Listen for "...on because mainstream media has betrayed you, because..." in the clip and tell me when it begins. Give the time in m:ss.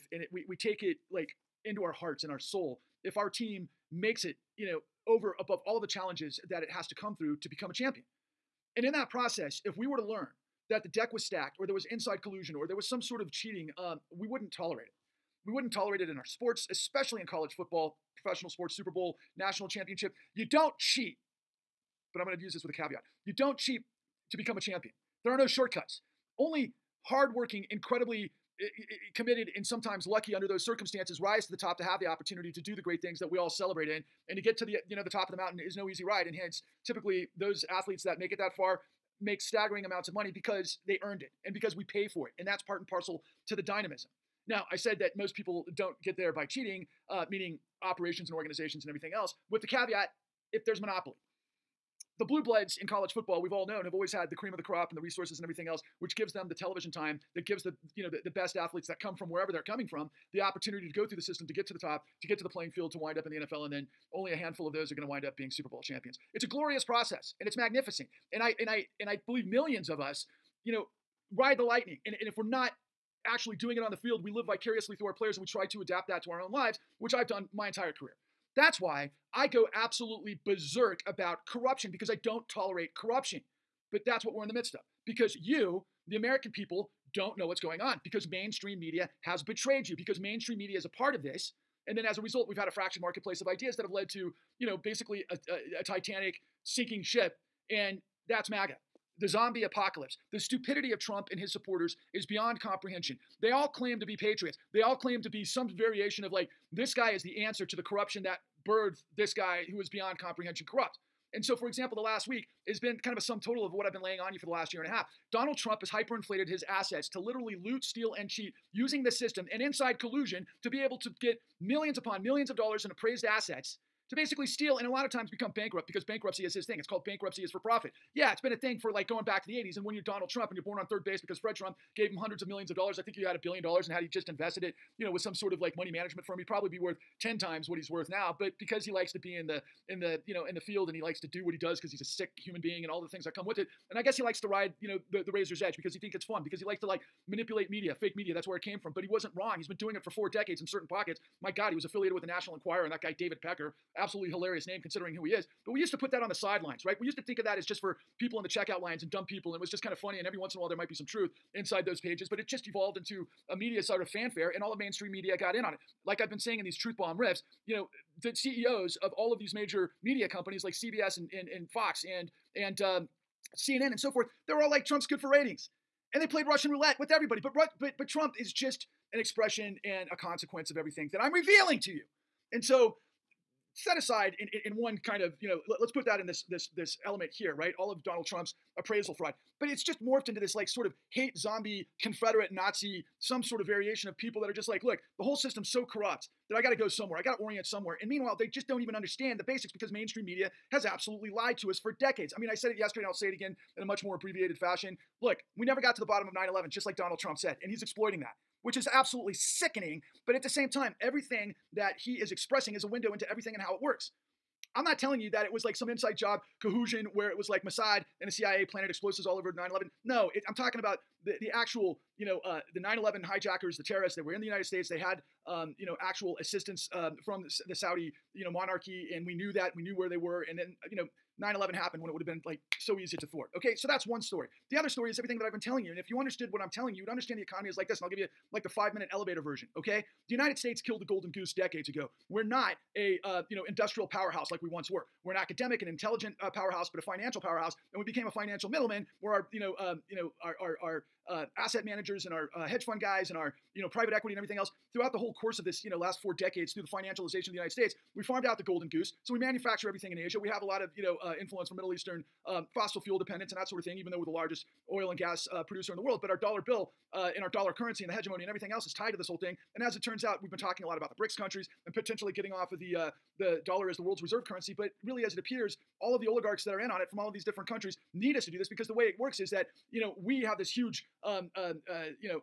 1:27.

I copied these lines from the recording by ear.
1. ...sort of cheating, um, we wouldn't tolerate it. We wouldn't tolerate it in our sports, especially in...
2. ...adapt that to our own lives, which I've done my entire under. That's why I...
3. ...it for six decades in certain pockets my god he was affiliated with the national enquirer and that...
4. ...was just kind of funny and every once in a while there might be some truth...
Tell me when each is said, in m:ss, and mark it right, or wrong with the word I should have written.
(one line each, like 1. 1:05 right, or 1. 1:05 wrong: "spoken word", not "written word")
1. 0:13 right
2. 1:15 wrong: "career", not "under"
3. 2:29 wrong: "four", not "six"
4. 2:39 right.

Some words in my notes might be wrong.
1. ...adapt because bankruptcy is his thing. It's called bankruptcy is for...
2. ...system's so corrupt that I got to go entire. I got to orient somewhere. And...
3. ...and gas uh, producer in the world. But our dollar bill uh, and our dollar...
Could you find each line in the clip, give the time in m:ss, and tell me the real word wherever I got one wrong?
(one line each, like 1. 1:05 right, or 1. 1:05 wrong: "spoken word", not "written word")
1. 2:05 wrong: "bankrupt", not "adapt"
2. 3:15 wrong: "somewhere", not "entire"
3. 4:25 right.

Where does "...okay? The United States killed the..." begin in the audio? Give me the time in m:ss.
3:59.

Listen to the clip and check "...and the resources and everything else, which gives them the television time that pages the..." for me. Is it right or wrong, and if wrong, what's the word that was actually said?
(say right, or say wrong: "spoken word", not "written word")
wrong: "gives", not "pages".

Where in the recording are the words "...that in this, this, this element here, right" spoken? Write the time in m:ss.
3:06.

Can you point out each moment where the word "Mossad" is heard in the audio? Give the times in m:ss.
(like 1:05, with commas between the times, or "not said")
3:37.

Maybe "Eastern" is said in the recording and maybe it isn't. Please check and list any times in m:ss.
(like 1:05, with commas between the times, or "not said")
4:21.